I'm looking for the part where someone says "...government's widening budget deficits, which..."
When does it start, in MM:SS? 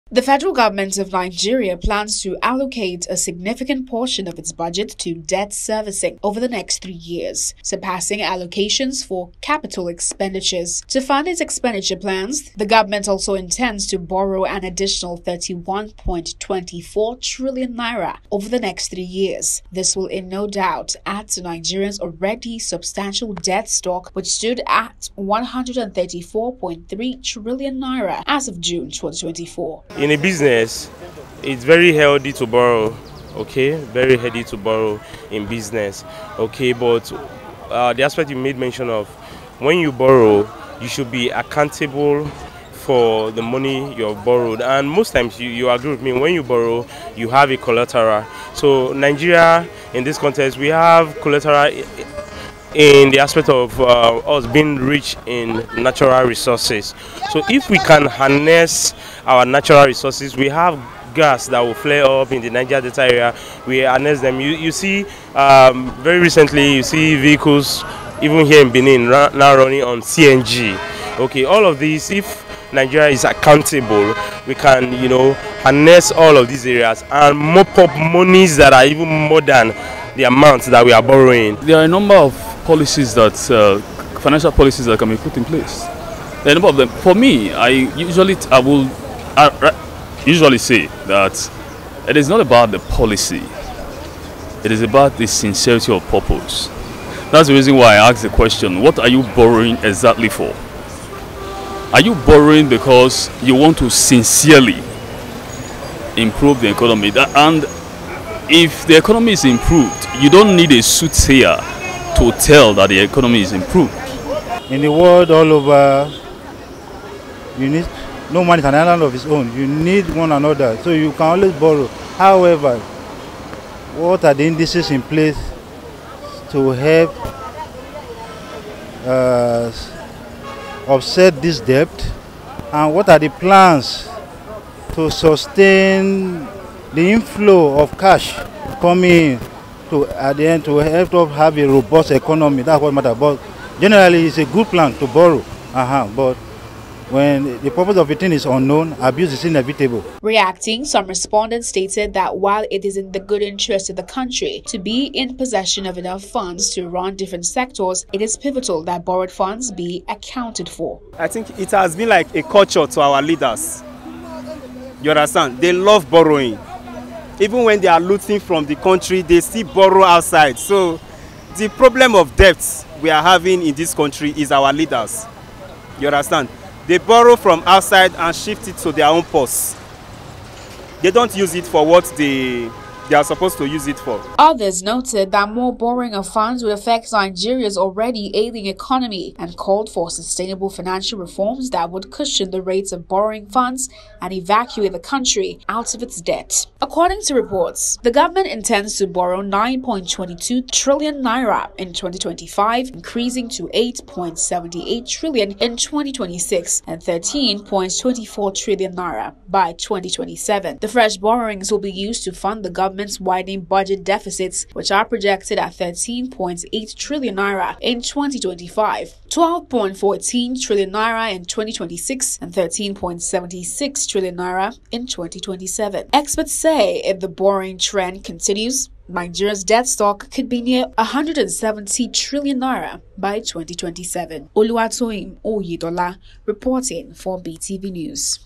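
03:33.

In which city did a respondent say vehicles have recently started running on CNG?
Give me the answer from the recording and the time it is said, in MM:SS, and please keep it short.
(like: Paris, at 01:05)
Benin, at 01:08.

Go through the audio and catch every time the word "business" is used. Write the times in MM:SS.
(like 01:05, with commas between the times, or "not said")
00:30, 00:35.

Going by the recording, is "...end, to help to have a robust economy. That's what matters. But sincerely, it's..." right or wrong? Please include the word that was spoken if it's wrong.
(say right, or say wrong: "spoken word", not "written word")
wrong: "generally", not "sincerely".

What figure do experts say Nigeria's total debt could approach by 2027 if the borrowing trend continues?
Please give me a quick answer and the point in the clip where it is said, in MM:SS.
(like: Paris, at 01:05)
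170 trillion naira, at 03:50.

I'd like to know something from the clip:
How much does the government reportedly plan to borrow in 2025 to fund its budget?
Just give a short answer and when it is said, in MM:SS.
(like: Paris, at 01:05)
9.22 trillion naira, at 03:19.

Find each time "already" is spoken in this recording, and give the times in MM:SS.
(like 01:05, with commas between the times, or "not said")
00:22, 03:07.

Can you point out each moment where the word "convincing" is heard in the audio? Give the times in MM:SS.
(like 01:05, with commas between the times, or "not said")
not said.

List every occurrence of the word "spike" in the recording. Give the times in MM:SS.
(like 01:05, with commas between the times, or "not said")
not said.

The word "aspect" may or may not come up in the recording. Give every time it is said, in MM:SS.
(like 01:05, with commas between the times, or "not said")
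00:38, 00:53.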